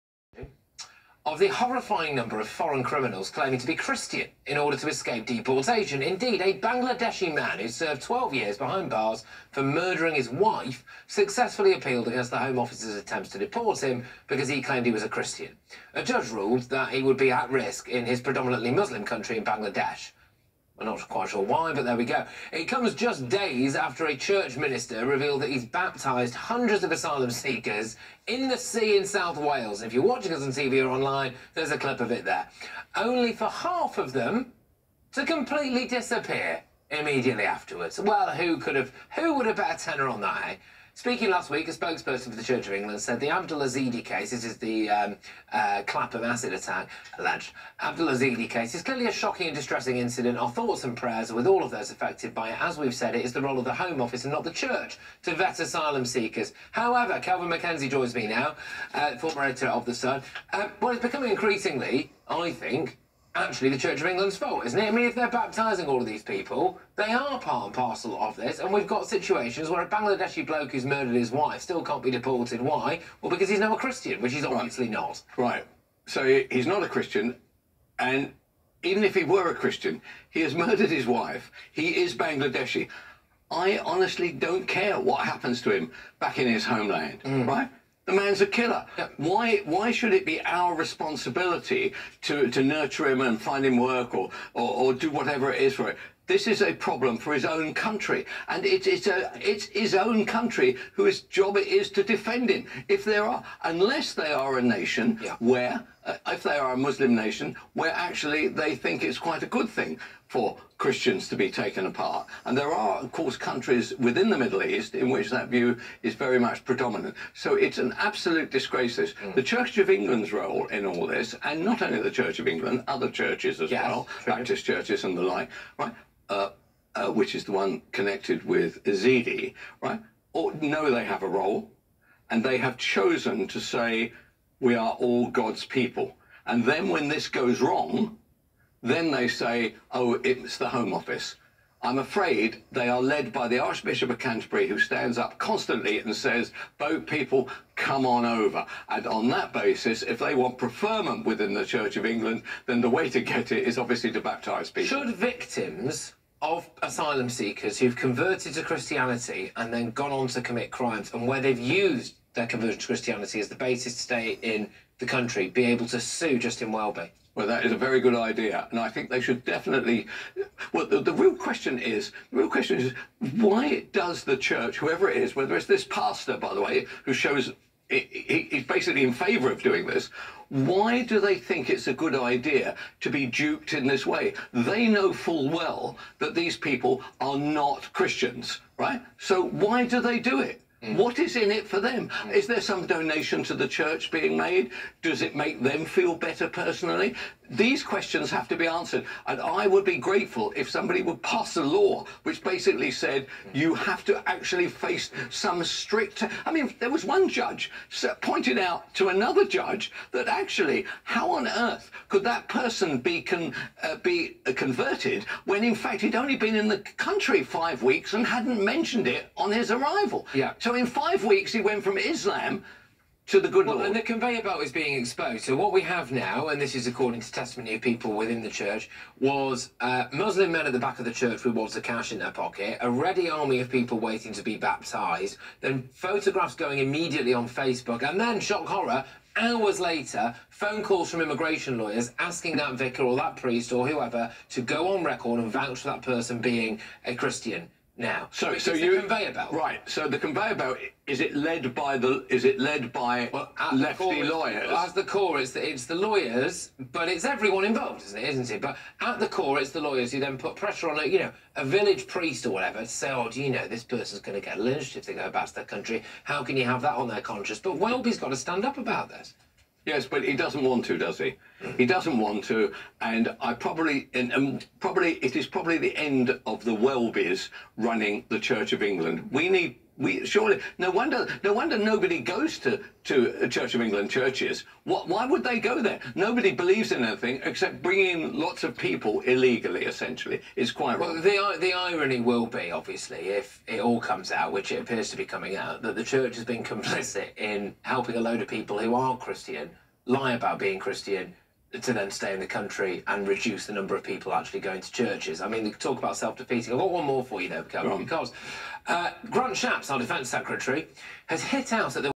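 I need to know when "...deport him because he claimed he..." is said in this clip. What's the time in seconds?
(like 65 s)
13 s.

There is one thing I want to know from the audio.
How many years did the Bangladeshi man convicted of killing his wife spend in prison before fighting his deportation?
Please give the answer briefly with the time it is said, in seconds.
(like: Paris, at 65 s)
12, at 8 s.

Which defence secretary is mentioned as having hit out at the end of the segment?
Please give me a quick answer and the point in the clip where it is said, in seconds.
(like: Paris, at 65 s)
Grant Shapps, at 309 s.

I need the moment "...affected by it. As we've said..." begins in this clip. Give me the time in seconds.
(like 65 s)
51 s.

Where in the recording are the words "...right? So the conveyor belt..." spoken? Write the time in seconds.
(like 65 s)
249 s.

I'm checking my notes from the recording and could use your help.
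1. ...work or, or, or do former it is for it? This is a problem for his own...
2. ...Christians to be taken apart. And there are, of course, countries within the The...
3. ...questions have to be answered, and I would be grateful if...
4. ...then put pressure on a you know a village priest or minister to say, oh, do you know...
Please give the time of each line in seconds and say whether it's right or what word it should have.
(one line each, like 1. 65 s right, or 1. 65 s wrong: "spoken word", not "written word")
1. 93 s wrong: "whatever", not "former"
2. 110 s wrong: "Middle", not "The"
3. 197 s right
4. 260 s wrong: "whatever", not "minister".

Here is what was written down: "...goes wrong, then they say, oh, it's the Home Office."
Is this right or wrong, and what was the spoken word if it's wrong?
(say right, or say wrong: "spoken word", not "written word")
right.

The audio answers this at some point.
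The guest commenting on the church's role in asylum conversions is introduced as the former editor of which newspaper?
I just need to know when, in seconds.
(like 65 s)
59 s.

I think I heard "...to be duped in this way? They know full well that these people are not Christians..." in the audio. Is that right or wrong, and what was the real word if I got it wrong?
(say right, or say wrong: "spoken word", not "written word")
right.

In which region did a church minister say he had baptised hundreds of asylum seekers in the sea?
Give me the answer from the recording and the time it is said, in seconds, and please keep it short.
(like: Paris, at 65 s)
South Wales, at 29 s.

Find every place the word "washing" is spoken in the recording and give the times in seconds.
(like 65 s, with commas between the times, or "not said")
not said.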